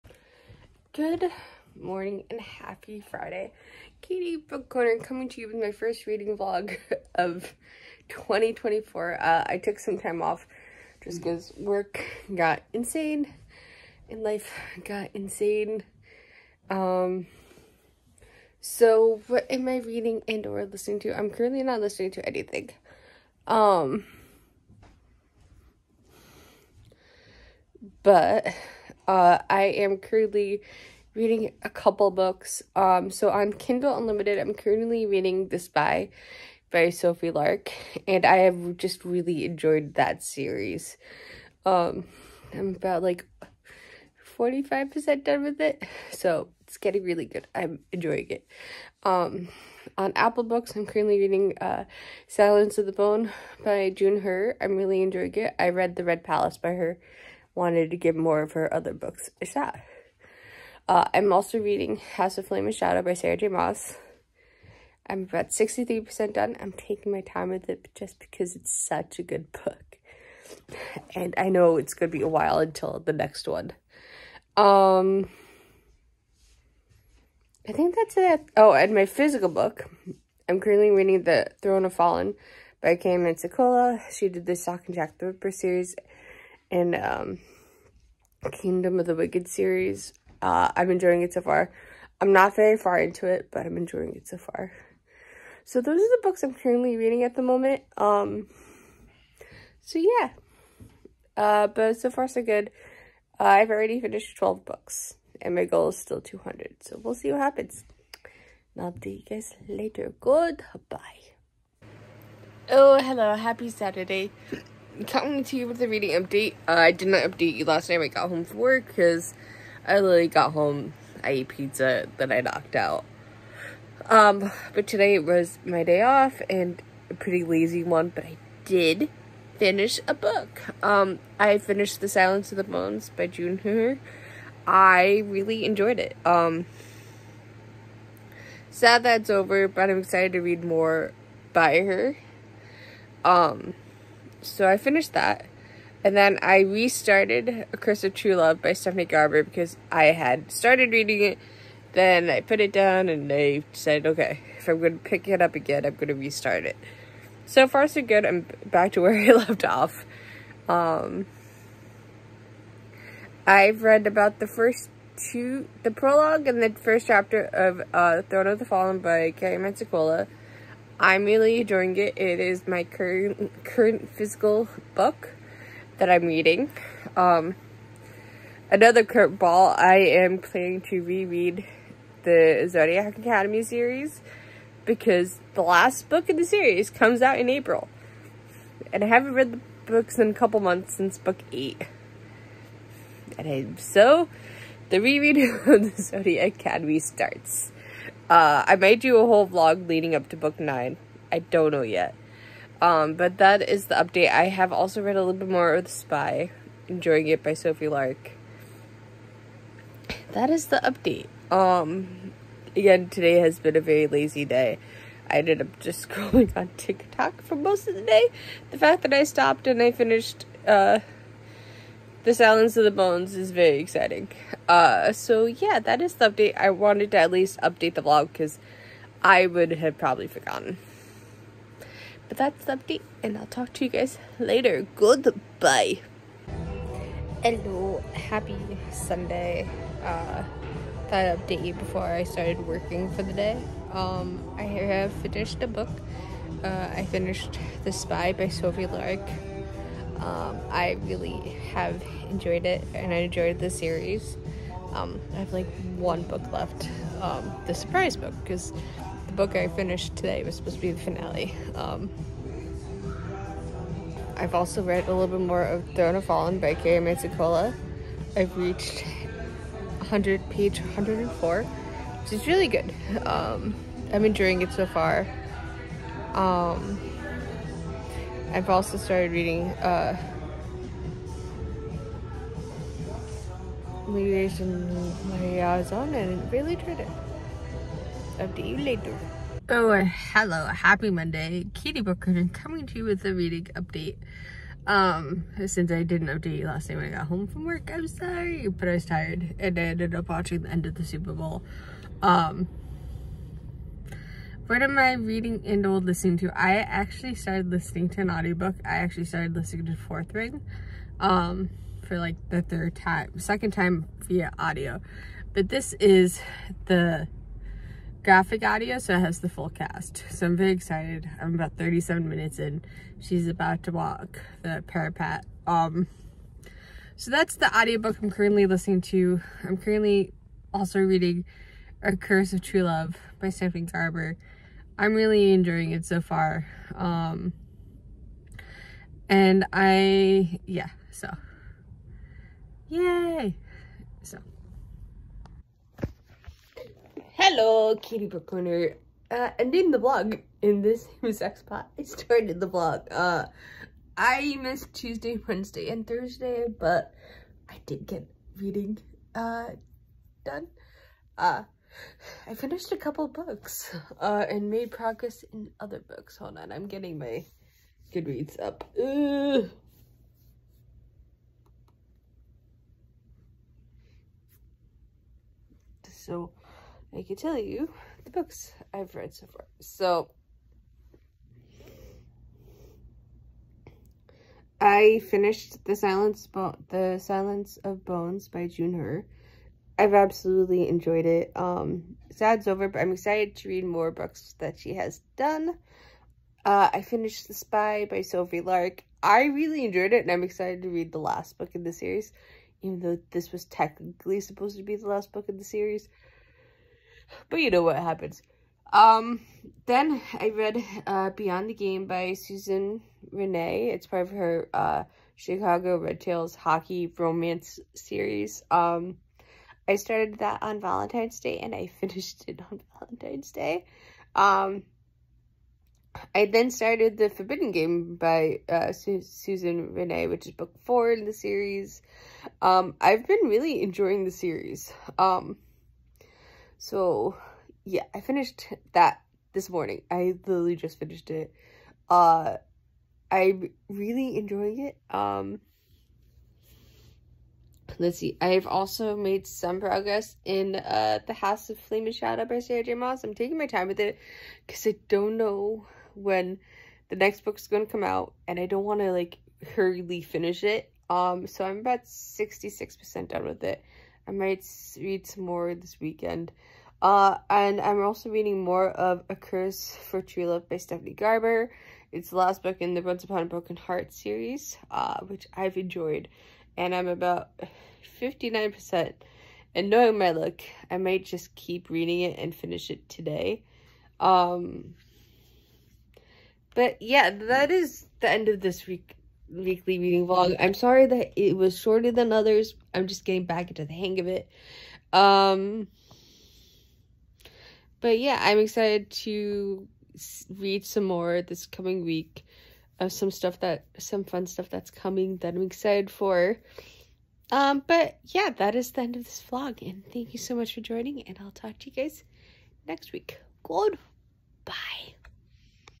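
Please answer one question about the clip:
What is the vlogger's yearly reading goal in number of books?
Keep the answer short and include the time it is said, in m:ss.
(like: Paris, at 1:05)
200, at 1:46.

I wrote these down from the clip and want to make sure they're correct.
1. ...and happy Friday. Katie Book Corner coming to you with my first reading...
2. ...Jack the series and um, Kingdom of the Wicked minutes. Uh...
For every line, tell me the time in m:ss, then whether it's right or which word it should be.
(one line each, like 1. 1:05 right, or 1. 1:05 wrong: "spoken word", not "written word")
1. 0:02 right
2. 1:24 wrong: "series", not "minutes".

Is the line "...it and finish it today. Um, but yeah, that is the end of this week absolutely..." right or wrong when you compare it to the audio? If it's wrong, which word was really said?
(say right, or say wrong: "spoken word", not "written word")
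wrong: "weekly", not "absolutely".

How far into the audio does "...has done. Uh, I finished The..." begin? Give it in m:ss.
6:34.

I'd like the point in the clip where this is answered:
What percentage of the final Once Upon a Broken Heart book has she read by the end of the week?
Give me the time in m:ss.
7:58.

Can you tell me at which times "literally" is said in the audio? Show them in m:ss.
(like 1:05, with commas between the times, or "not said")
1:59, 7:20.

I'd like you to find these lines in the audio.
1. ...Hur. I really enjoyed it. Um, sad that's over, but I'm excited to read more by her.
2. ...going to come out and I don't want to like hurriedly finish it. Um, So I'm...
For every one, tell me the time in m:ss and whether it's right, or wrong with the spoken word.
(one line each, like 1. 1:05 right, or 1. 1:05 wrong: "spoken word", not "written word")
1. 2:13 right
2. 7:37 right.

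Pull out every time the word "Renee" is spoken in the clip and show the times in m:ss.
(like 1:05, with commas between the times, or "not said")
6:53, 7:09.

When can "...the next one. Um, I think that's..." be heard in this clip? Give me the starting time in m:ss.
1:13.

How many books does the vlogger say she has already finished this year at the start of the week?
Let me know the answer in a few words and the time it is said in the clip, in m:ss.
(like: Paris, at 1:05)
12, at 1:44.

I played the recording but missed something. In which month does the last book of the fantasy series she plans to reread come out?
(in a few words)
April.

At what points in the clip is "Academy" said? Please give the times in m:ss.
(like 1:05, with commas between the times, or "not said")
3:03, 3:16.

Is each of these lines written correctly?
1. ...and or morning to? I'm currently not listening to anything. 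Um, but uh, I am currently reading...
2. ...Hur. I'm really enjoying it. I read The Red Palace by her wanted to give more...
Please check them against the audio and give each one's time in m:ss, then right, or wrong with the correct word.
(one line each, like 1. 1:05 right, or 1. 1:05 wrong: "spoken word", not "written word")
1. 0:20 wrong: "listening", not "morning"
2. 0:54 right.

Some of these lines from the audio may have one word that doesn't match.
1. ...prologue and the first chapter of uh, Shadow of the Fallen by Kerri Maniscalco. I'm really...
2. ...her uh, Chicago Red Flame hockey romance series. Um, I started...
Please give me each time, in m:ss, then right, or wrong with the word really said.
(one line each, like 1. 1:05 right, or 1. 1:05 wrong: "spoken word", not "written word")
1. 2:45 wrong: "Throne", not "Shadow"
2. 6:54 wrong: "Tails", not "Flame".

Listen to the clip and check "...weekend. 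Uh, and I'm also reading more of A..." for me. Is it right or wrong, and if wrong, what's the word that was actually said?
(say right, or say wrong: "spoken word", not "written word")
right.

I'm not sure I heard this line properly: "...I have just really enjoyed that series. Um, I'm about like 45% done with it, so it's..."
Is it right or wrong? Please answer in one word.
right.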